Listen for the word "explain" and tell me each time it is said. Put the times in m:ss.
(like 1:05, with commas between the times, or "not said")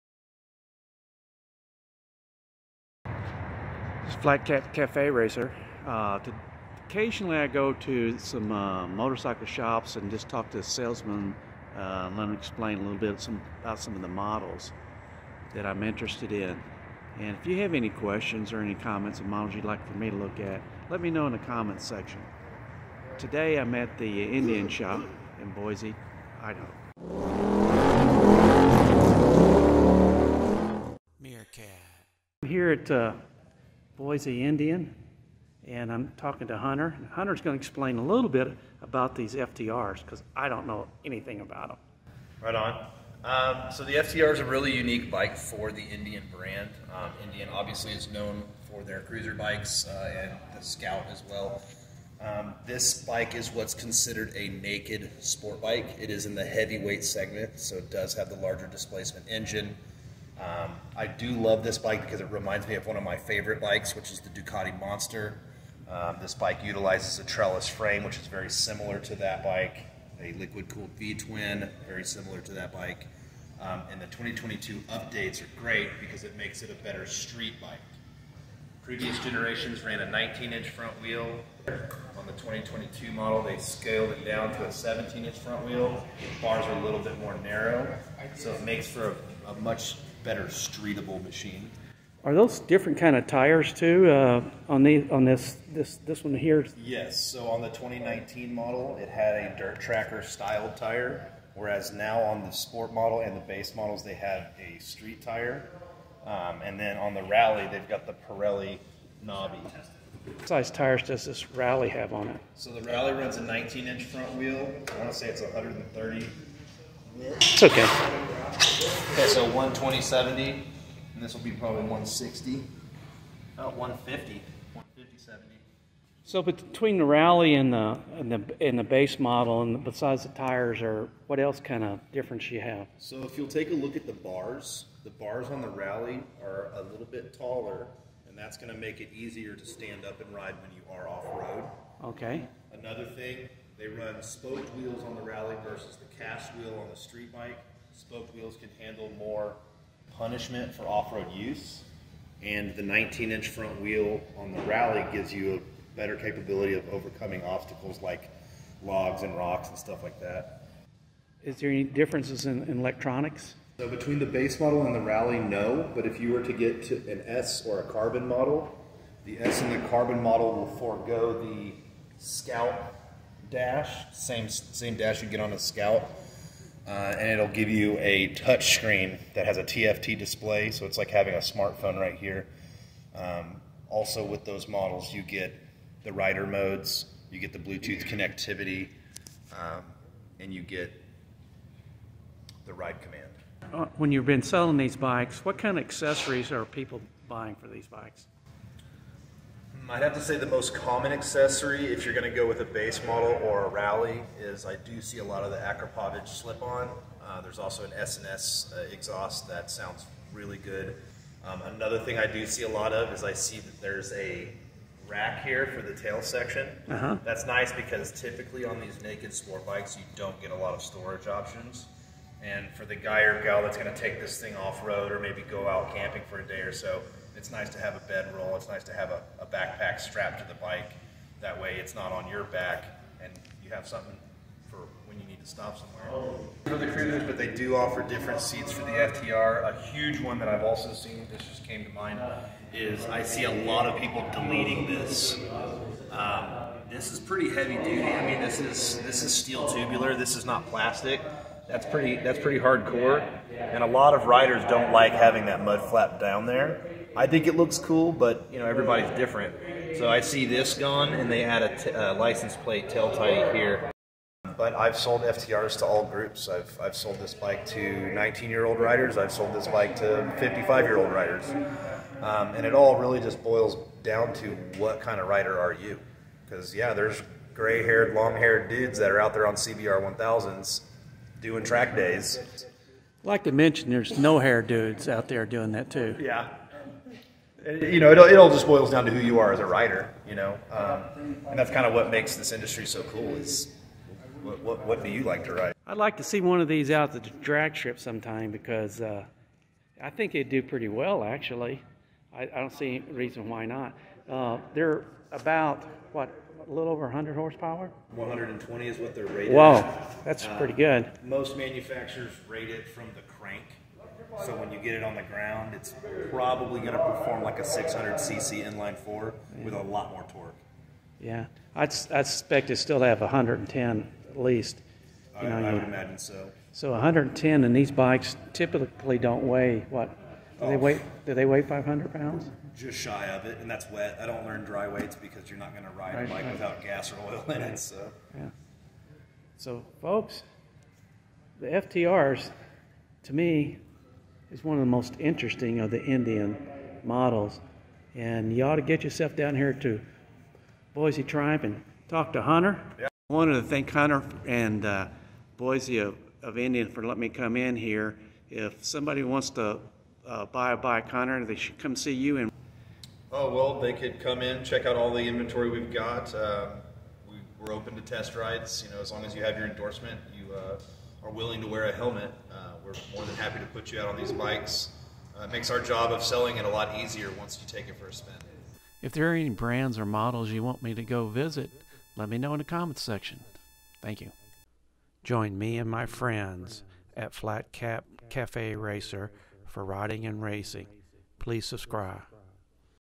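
0:12, 0:37.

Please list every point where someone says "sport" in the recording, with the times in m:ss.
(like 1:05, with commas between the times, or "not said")
0:55, 1:42, 3:39.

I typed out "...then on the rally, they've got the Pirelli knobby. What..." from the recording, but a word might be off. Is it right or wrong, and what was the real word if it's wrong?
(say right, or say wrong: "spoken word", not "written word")
right.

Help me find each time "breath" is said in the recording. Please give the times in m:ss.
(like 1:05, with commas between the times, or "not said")
not said.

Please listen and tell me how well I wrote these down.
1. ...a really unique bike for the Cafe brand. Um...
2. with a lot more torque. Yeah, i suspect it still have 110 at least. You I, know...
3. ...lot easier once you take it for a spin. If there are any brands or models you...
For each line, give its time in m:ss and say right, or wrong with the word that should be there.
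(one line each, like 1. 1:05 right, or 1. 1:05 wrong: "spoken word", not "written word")
1. 0:44 wrong: "Indian", not "Cafe"
2. 5:19 right
3. 6:16 right.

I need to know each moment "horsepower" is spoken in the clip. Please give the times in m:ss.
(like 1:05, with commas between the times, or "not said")
5:07.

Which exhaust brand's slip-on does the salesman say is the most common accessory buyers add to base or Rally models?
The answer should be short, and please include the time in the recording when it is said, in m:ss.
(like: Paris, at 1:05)
Akrapovic, at 3:25.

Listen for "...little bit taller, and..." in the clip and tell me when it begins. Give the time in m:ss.
2:16.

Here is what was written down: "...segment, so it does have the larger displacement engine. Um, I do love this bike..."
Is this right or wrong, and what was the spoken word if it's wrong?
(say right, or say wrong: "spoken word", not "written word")
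right.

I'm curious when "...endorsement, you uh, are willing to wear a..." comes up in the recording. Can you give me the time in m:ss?
6:09.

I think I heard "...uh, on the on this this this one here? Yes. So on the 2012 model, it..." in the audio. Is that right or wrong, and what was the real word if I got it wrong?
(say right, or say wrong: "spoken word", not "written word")
wrong: "2019", not "2012".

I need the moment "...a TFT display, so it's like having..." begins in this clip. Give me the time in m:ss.
2:59.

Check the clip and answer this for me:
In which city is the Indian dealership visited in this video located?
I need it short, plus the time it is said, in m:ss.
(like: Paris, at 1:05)
Boise, Idaho, at 0:25.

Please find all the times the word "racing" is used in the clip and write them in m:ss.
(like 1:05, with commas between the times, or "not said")
6:30.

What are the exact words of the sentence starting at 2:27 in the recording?
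Spoke wheels can handle more punishment for off-road use.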